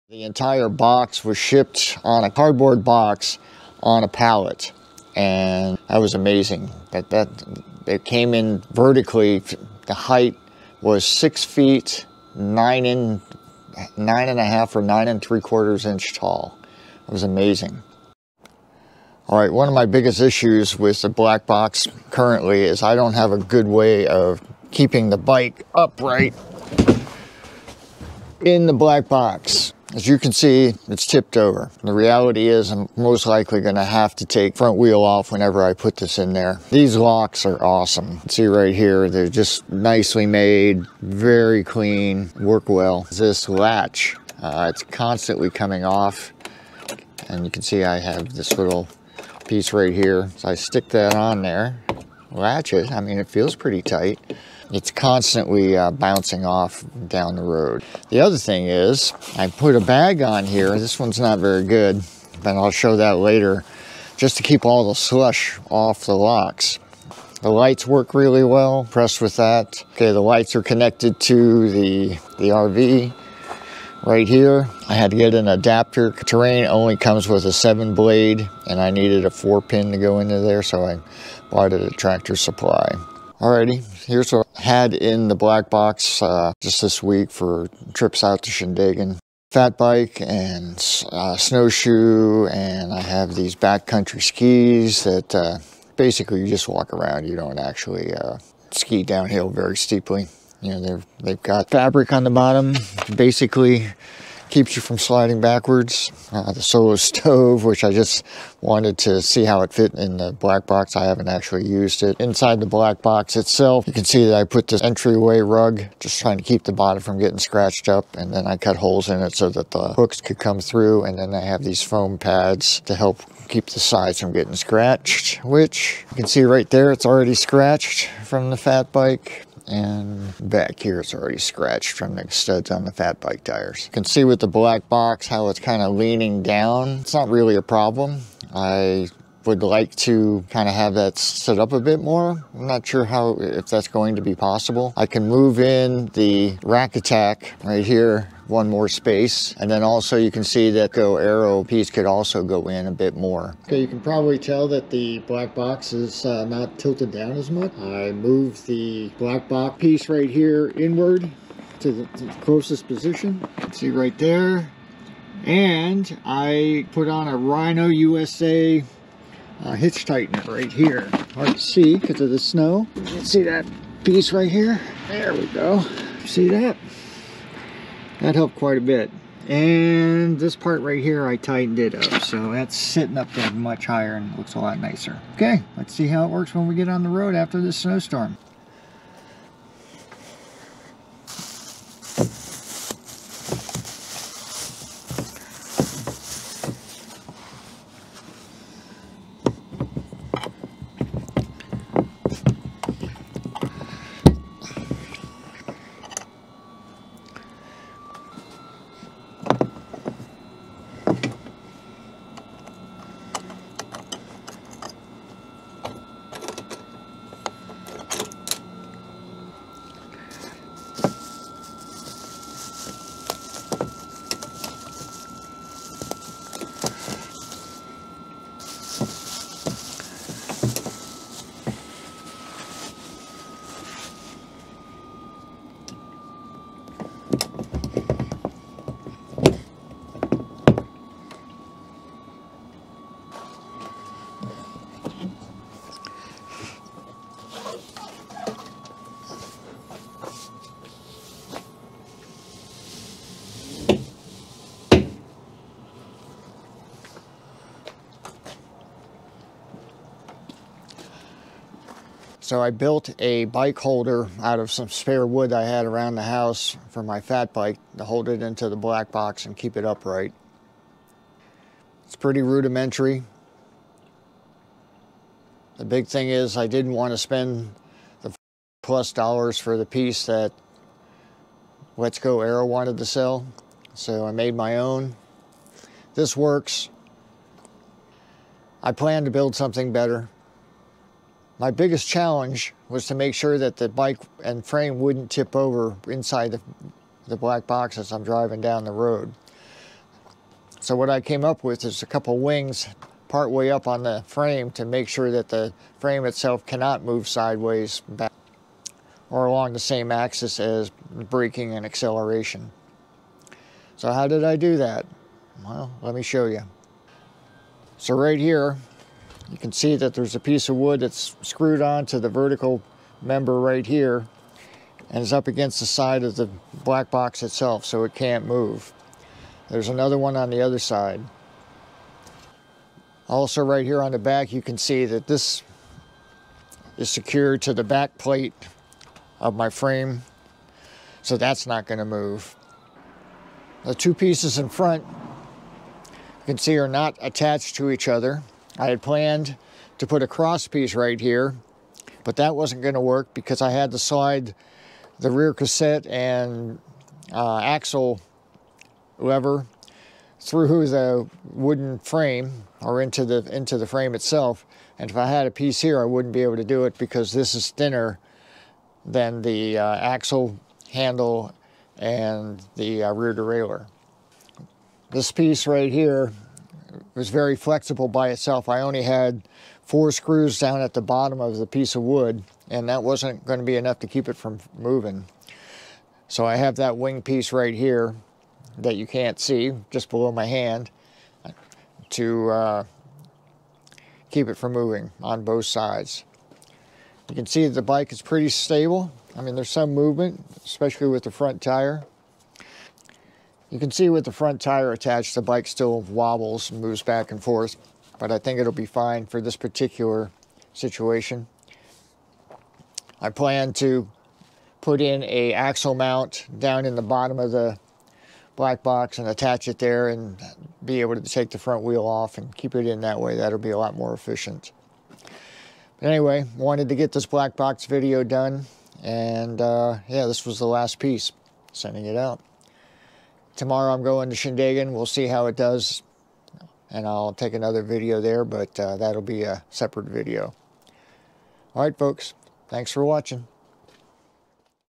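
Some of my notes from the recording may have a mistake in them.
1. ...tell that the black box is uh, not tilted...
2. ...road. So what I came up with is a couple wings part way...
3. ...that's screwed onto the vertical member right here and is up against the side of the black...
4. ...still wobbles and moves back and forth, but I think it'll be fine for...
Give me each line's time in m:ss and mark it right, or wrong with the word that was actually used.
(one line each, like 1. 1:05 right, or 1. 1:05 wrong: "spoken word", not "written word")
1. 2:34 right
2. 4:58 right
3. 5:21 right
4. 6:45 right.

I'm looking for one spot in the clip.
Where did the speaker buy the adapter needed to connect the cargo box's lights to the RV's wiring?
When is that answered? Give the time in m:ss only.
1:21.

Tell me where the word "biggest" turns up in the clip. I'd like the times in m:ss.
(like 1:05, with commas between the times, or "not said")
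0:19, 4:51.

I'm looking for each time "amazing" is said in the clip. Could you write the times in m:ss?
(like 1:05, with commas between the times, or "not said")
0:06, 0:17.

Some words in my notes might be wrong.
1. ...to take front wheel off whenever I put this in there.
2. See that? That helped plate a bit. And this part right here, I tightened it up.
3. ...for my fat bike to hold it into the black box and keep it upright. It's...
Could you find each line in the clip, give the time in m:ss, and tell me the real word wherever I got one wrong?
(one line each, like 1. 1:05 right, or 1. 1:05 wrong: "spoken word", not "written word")
1. 0:34 right
2. 2:56 wrong: "quite", not "plate"
3. 4:26 right.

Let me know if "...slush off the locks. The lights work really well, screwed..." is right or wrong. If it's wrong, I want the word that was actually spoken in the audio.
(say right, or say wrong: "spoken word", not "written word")
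wrong: "impressed", not "screwed".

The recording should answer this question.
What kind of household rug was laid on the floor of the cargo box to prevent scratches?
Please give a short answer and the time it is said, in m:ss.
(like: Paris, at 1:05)
entryway rug, at 1:54.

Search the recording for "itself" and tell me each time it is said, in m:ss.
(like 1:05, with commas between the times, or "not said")
1:53, 5:06, 5:27, 6:04, 6:18.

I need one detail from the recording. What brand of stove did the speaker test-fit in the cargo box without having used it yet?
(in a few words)
Solo stove.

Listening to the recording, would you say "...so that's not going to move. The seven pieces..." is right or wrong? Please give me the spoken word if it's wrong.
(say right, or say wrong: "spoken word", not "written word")
wrong: "two", not "seven".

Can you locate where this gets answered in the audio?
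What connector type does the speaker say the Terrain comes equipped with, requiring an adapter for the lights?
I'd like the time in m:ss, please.
1:17.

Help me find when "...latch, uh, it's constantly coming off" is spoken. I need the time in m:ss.
0:43.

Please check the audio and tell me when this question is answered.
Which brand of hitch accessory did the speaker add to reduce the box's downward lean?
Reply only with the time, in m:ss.
2:47.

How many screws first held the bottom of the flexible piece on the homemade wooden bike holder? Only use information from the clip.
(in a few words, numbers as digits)
4.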